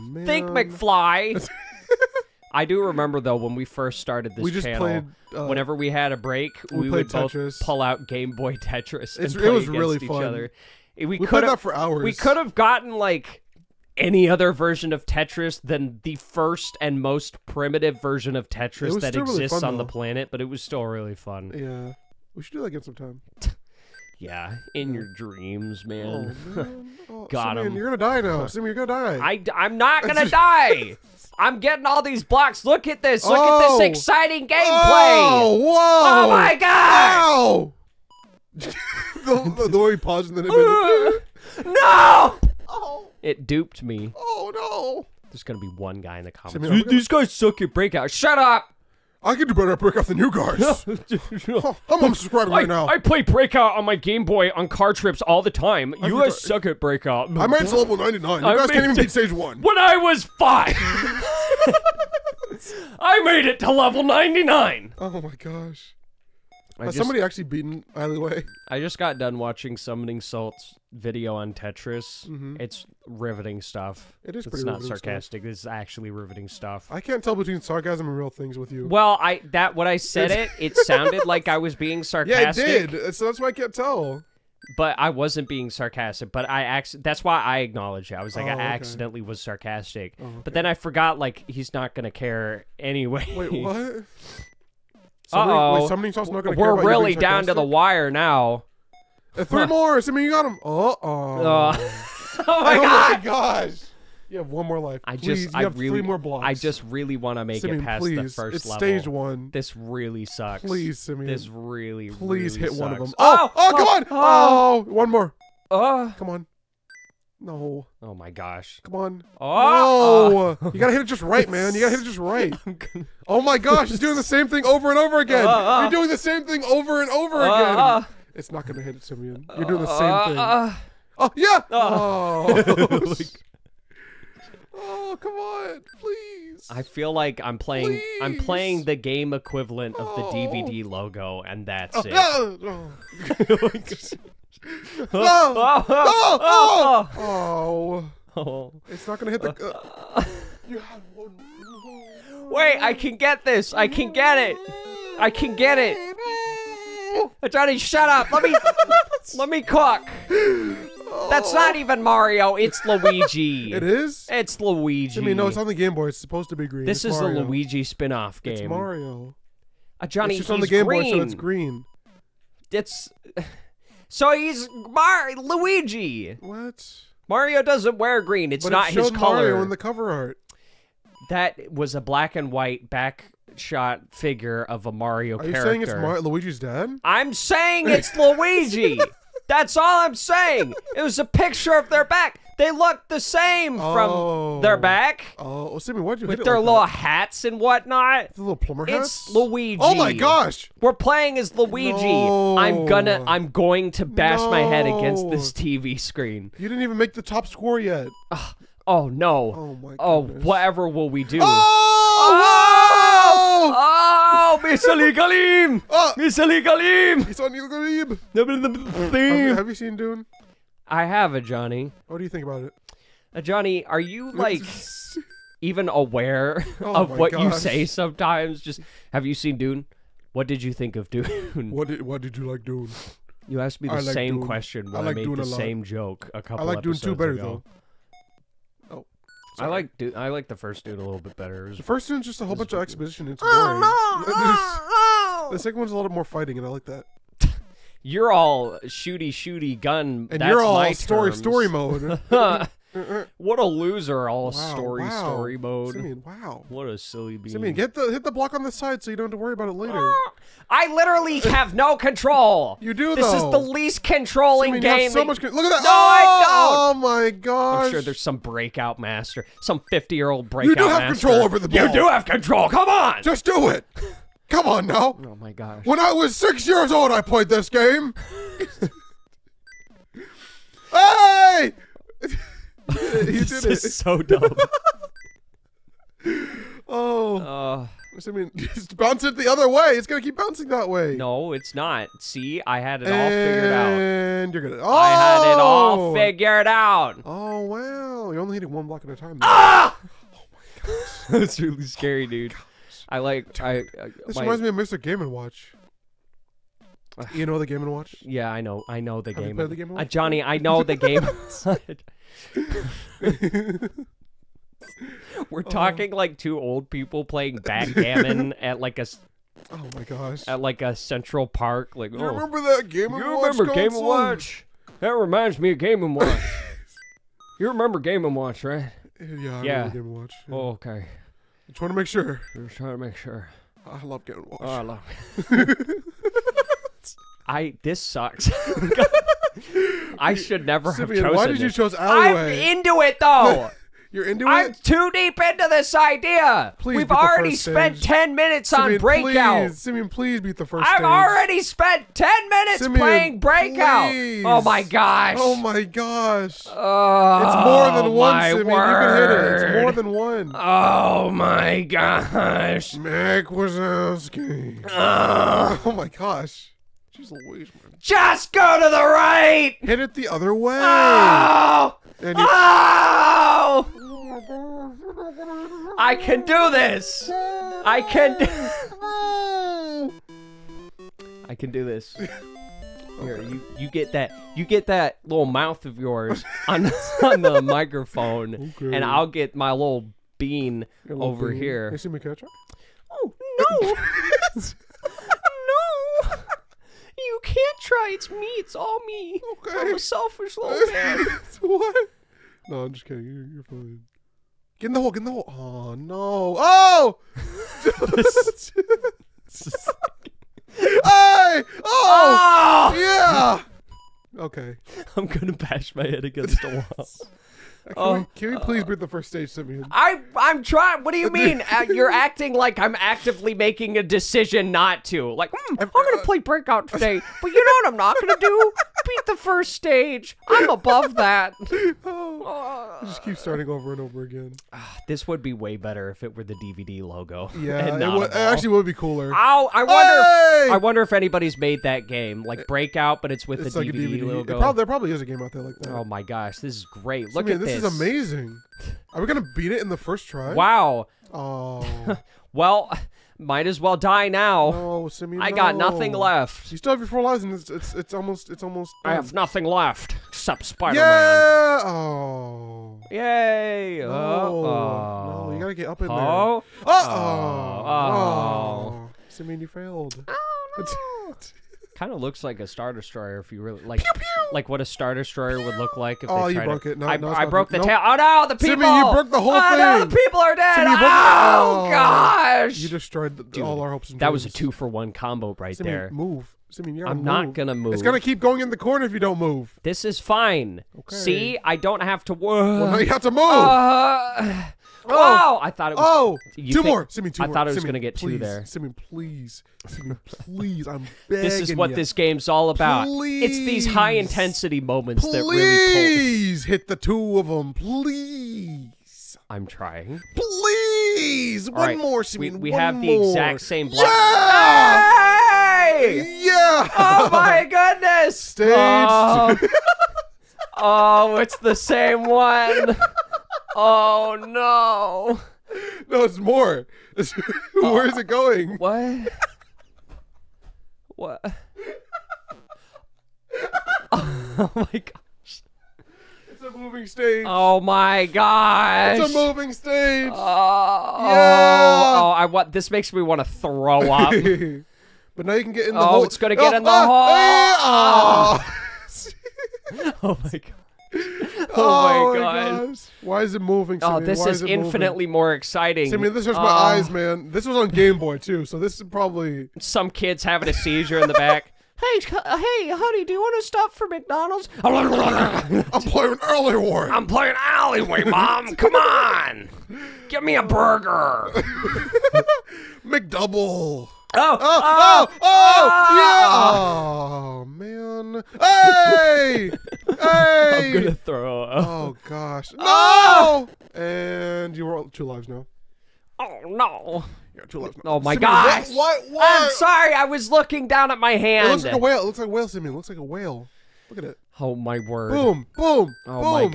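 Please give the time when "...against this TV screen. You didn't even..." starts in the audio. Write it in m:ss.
3:24.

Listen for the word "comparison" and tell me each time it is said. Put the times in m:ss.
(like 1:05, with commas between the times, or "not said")
not said.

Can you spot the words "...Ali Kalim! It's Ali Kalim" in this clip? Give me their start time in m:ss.
3:36.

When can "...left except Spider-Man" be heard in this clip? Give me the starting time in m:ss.
7:39.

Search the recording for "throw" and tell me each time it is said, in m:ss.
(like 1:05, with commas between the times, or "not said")
9:03, 9:41.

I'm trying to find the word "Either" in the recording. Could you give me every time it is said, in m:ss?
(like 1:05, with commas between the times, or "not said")
1:07.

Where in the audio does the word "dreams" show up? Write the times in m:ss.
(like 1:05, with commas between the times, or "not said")
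0:25, 8:04.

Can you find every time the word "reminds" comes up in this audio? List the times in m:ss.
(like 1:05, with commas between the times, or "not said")
5:04, 5:25.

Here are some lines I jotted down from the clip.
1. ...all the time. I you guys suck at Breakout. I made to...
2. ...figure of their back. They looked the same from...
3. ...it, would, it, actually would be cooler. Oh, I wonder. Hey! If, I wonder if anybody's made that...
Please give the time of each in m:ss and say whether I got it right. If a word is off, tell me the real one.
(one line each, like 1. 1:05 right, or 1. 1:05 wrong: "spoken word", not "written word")
1. 0:55 right
2. 3:11 wrong: "picture", not "figure"
3. 7:17 right.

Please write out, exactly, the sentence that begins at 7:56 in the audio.
No, I, no, I broke the nope.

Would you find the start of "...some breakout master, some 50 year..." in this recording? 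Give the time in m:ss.
4:28.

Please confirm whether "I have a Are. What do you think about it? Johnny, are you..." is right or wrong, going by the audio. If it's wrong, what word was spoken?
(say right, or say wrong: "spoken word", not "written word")
wrong: "Johnny", not "Are".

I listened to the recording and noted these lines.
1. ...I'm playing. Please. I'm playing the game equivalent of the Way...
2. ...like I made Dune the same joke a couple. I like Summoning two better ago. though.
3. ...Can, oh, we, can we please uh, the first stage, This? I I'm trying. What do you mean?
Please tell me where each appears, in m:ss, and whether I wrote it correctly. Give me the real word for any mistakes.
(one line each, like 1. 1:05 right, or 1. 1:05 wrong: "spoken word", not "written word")
1. 2:17 wrong: "DVD", not "Way"
2. 3:55 wrong: "Dune", not "Summoning"
3. 6:57 wrong: "Simeon", not "This".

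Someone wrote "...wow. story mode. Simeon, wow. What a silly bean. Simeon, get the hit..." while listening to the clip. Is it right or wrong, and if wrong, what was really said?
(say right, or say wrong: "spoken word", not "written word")
right.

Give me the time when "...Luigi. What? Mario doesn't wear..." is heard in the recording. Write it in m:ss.
2:55.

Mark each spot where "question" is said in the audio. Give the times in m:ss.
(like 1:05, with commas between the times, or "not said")
3:54.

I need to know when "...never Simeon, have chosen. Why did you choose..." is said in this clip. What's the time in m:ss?
5:40.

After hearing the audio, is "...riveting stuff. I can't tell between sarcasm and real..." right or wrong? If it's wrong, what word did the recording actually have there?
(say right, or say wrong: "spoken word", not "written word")
right.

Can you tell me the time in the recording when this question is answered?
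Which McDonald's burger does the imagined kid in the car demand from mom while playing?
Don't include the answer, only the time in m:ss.
9:33.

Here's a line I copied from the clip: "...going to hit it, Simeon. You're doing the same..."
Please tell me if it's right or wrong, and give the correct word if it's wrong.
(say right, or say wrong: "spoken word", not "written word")
right.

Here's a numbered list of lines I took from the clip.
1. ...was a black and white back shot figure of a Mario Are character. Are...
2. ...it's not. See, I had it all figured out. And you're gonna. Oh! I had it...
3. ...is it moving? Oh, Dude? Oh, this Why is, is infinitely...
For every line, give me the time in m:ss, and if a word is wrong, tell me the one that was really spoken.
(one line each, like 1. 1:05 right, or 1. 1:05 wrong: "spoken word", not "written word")
1. 3:01 right
2. 4:51 right
3. 9:13 wrong: "Simeon", not "Dude".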